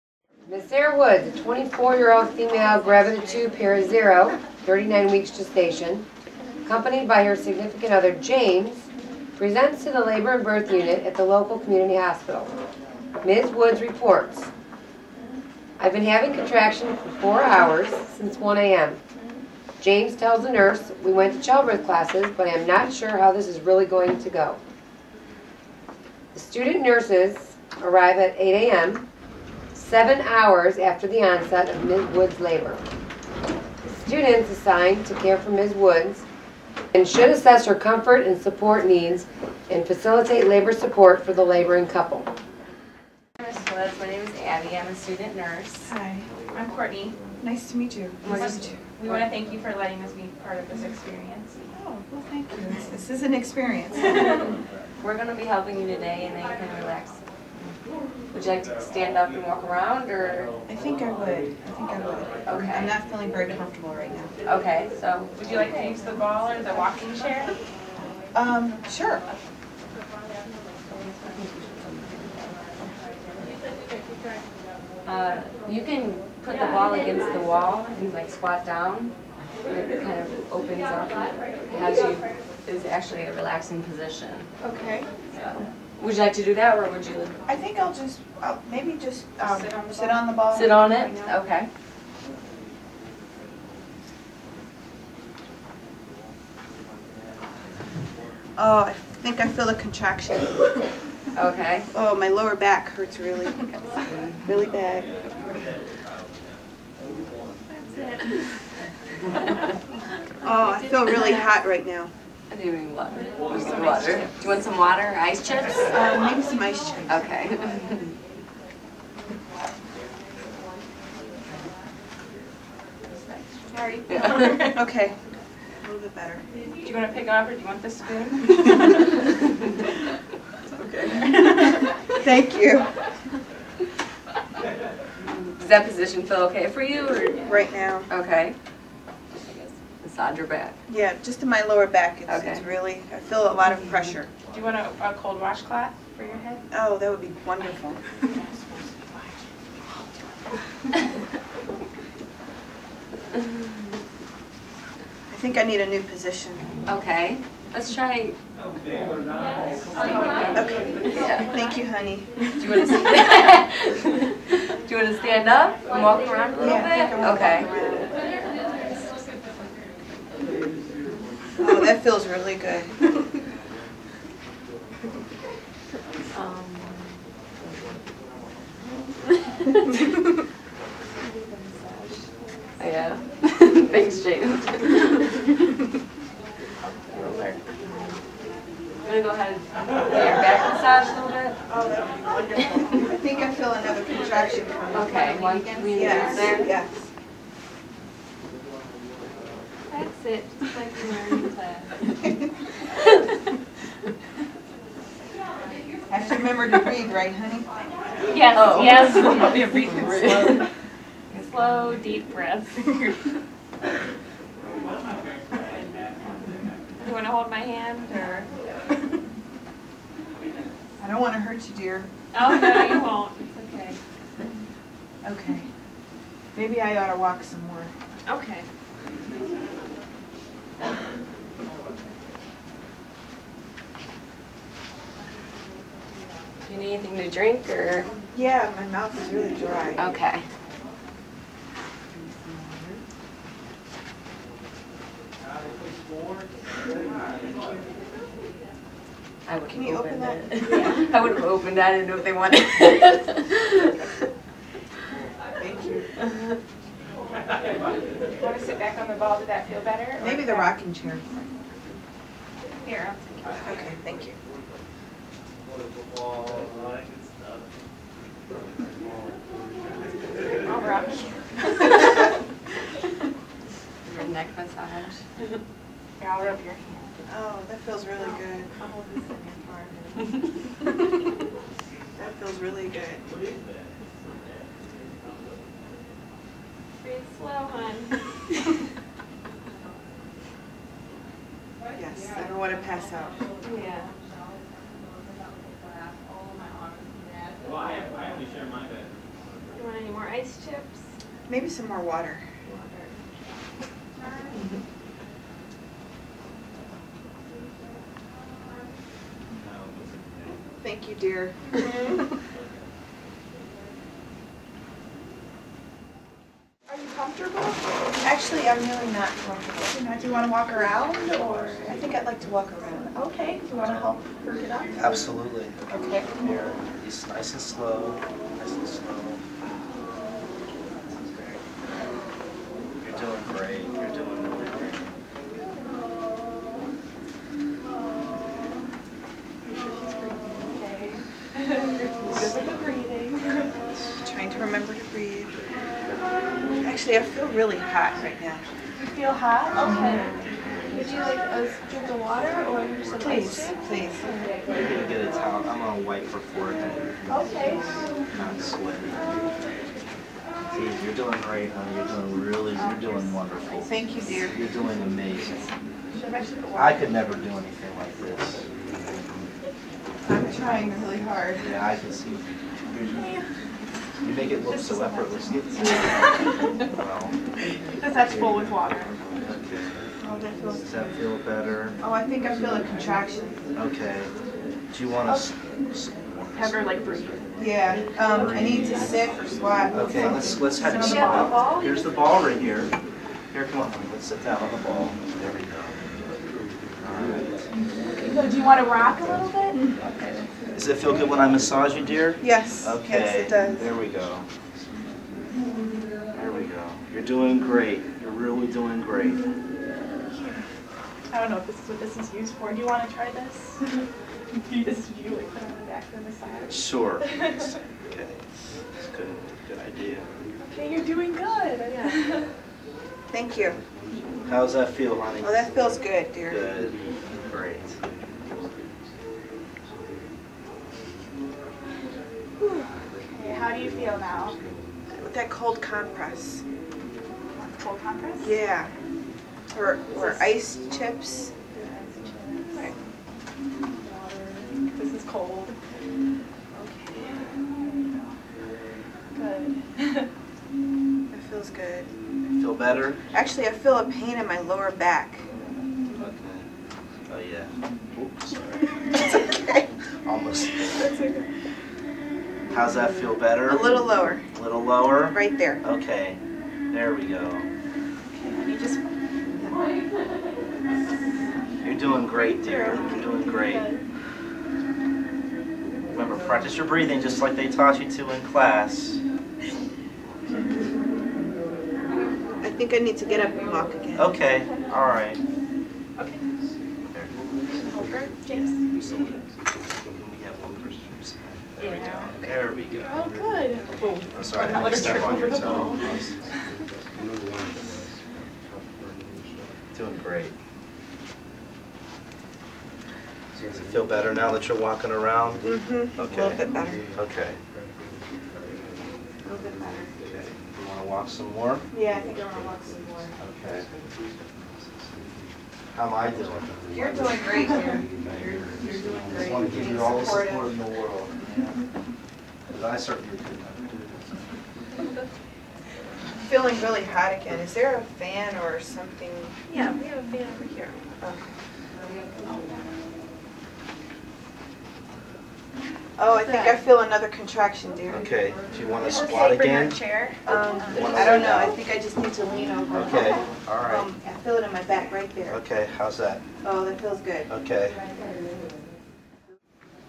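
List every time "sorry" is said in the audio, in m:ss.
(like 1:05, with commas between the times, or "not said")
2:03, 7:38, 8:14.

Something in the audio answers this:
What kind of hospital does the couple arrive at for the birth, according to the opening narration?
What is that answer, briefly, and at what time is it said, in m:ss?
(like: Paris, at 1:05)
Local community hospital, at 0:11.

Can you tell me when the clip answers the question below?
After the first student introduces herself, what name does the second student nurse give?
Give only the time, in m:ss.
0:46.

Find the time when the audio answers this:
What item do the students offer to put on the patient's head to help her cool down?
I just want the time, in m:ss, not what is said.
2:25.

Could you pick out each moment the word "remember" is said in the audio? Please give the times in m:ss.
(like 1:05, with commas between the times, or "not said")
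3:26, 5:44, 7:56.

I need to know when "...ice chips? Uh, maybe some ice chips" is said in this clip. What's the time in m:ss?
1:55.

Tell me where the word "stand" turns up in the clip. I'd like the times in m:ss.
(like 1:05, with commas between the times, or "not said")
0:58, 2:45.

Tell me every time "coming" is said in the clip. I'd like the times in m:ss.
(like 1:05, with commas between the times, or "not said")
3:14.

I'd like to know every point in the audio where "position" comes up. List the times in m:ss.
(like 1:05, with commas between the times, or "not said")
1:23, 2:15, 2:36.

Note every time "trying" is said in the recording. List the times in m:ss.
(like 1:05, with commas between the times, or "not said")
5:44, 6:10.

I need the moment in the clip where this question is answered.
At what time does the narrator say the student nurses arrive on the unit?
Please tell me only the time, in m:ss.
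0:28.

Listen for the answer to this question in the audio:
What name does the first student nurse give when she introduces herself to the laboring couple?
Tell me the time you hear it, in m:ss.
0:44.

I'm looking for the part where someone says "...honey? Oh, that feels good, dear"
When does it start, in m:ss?
7:05.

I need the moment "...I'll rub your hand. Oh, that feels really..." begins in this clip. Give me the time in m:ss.
4:36.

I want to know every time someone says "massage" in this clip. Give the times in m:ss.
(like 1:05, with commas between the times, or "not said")
3:10, 4:34, 6:41, 6:56.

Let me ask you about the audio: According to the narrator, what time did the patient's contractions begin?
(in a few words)
1 a.m.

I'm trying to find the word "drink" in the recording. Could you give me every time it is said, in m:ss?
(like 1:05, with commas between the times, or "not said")
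3:57, 5:51.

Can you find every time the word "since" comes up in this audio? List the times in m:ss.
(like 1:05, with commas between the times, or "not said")
0:18.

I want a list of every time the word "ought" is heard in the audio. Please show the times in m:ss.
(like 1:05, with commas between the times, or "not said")
3:46.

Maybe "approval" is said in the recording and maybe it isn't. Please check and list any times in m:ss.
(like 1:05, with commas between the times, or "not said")
not said.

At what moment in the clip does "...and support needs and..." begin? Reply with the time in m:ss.
0:38.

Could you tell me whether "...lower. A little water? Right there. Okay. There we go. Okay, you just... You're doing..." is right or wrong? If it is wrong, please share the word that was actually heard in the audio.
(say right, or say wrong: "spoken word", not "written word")
wrong: "lower", not "water".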